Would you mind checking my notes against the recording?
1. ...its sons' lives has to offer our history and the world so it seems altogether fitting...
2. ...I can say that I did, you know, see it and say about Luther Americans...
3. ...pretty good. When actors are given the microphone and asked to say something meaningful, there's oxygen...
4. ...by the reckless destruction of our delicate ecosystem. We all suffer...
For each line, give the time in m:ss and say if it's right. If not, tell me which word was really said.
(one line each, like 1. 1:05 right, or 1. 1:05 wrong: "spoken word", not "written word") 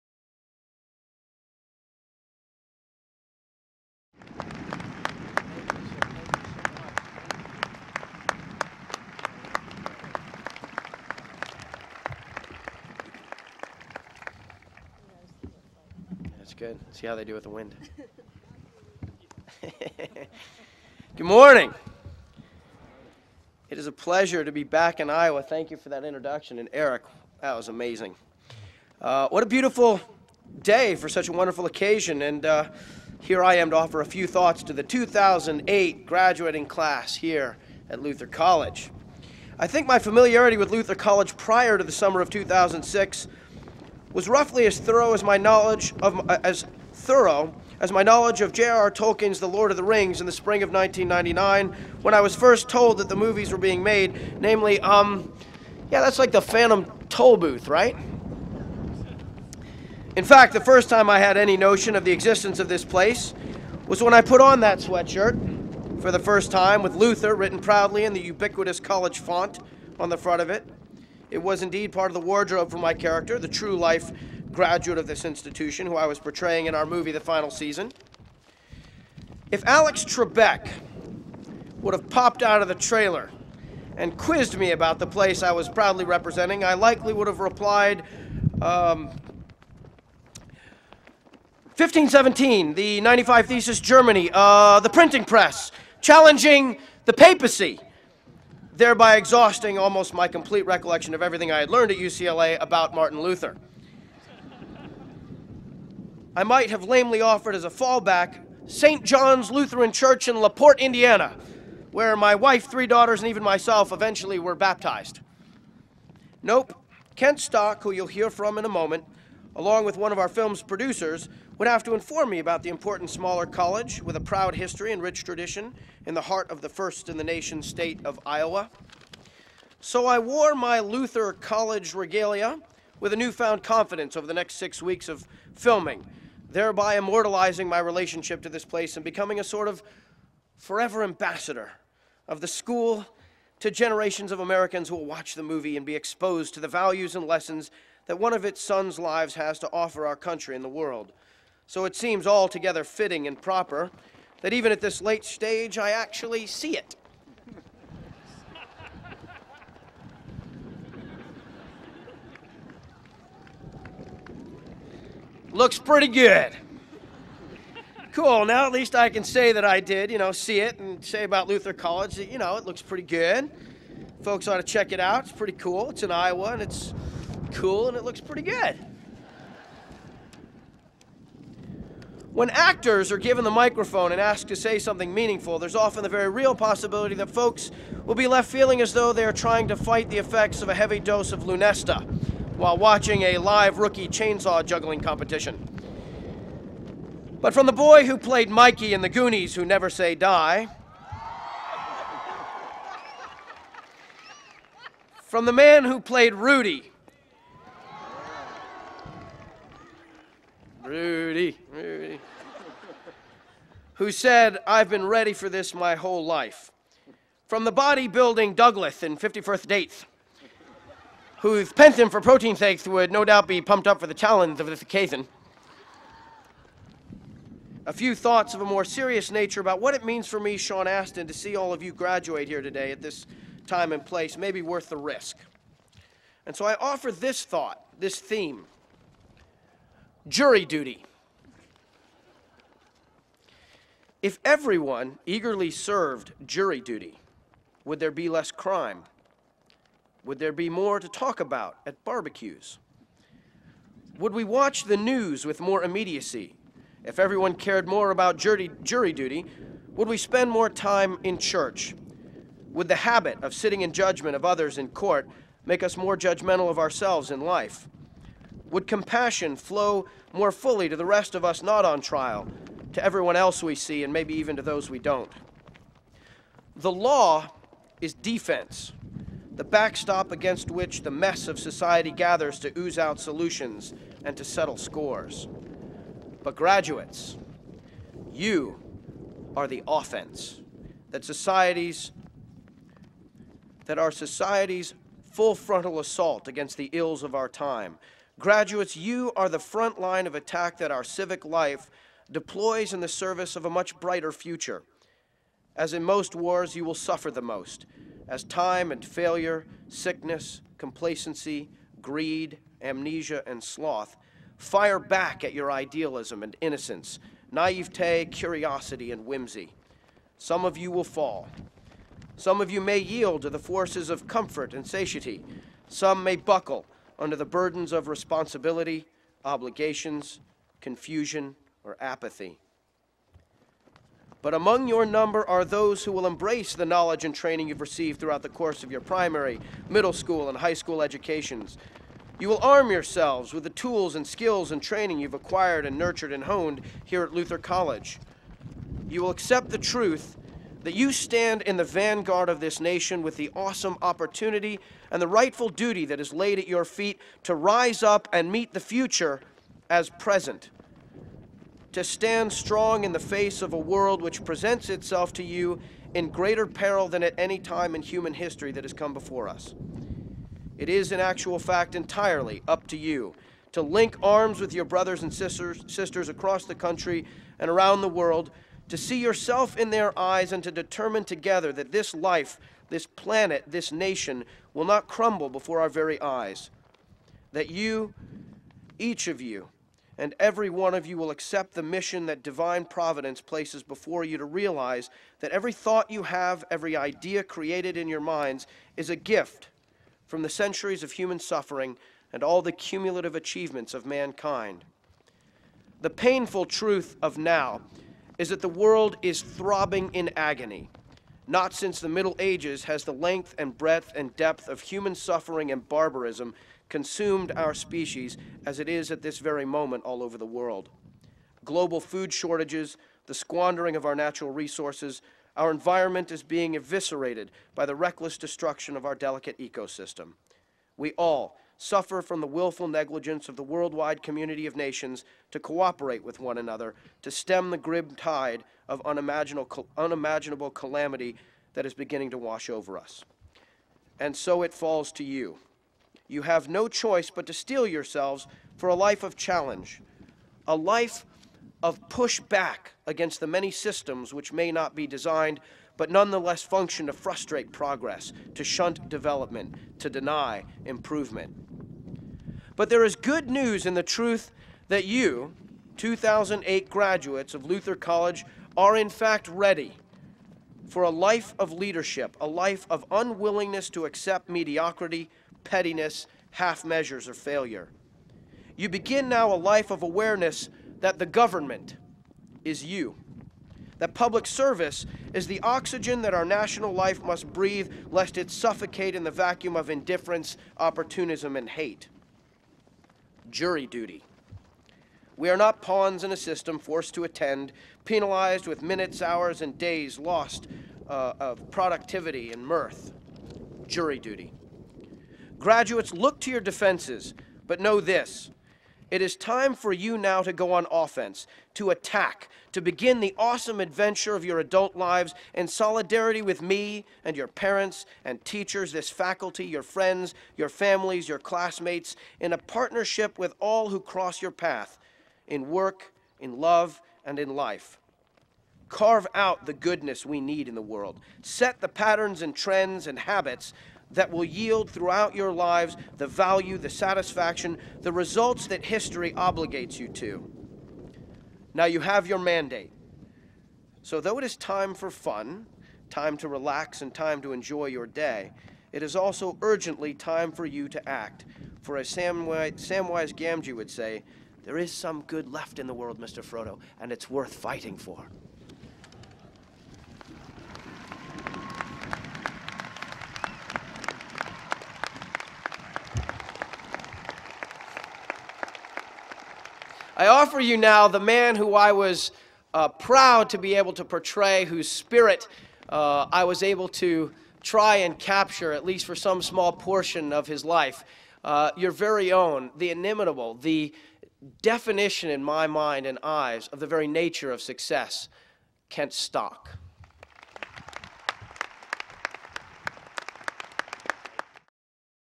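1. 2:28 wrong: "country", not "history"
2. 2:48 wrong: "College", not "Americans"
3. 2:58 wrong: "often", not "oxygen"
4. 7:07 right.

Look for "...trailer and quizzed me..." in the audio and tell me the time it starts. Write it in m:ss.
1:22.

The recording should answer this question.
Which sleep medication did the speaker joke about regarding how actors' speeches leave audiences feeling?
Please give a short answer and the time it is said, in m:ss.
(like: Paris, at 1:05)
Lunesta, at 3:11.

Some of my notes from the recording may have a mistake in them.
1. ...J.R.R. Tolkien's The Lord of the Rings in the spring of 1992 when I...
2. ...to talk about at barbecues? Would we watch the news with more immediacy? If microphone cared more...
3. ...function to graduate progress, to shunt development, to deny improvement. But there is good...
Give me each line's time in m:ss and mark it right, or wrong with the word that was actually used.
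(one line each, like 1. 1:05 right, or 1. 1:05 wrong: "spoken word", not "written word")
1. 0:48 wrong: "1999", not "1992"
2. 4:10 wrong: "everyone", not "microphone"
3. 7:36 wrong: "frustrate", not "graduate".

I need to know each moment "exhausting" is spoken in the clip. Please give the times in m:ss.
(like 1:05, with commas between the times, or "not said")
1:39.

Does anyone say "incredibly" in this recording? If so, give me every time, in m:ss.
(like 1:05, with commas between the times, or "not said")
not said.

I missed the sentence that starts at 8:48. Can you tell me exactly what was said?
Carve out the goodness we need in the world.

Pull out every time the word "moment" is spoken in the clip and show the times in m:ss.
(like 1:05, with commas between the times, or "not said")
1:58, 6:59.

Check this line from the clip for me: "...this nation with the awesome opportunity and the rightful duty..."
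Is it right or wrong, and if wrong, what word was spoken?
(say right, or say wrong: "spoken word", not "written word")
right.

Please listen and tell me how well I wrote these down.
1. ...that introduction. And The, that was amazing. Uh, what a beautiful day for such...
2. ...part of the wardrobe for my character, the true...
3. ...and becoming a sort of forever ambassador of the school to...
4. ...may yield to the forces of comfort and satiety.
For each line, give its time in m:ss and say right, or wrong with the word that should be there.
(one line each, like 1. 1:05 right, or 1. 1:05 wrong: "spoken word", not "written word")
1. 0:25 wrong: "Eric", not "The"
2. 1:11 right
3. 2:18 right
4. 5:22 right.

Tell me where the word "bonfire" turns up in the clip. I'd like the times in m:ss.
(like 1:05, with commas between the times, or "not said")
not said.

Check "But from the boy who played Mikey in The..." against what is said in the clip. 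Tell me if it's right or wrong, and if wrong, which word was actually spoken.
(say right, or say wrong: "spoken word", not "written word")
right.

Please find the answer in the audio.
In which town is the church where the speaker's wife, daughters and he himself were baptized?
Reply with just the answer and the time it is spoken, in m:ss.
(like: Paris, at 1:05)
LaPorte, Indiana, at 1:50.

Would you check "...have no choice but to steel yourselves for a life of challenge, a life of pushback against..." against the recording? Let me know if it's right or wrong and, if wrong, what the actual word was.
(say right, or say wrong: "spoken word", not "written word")
right.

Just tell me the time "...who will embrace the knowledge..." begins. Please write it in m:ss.
5:36.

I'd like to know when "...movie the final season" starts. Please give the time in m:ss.
1:16.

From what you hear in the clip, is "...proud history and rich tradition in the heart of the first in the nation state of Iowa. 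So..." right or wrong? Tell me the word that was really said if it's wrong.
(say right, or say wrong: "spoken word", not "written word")
right.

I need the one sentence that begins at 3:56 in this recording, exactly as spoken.
And so I offer this thought, this theme jury duty.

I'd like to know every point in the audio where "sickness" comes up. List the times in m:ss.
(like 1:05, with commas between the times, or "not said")
5:09.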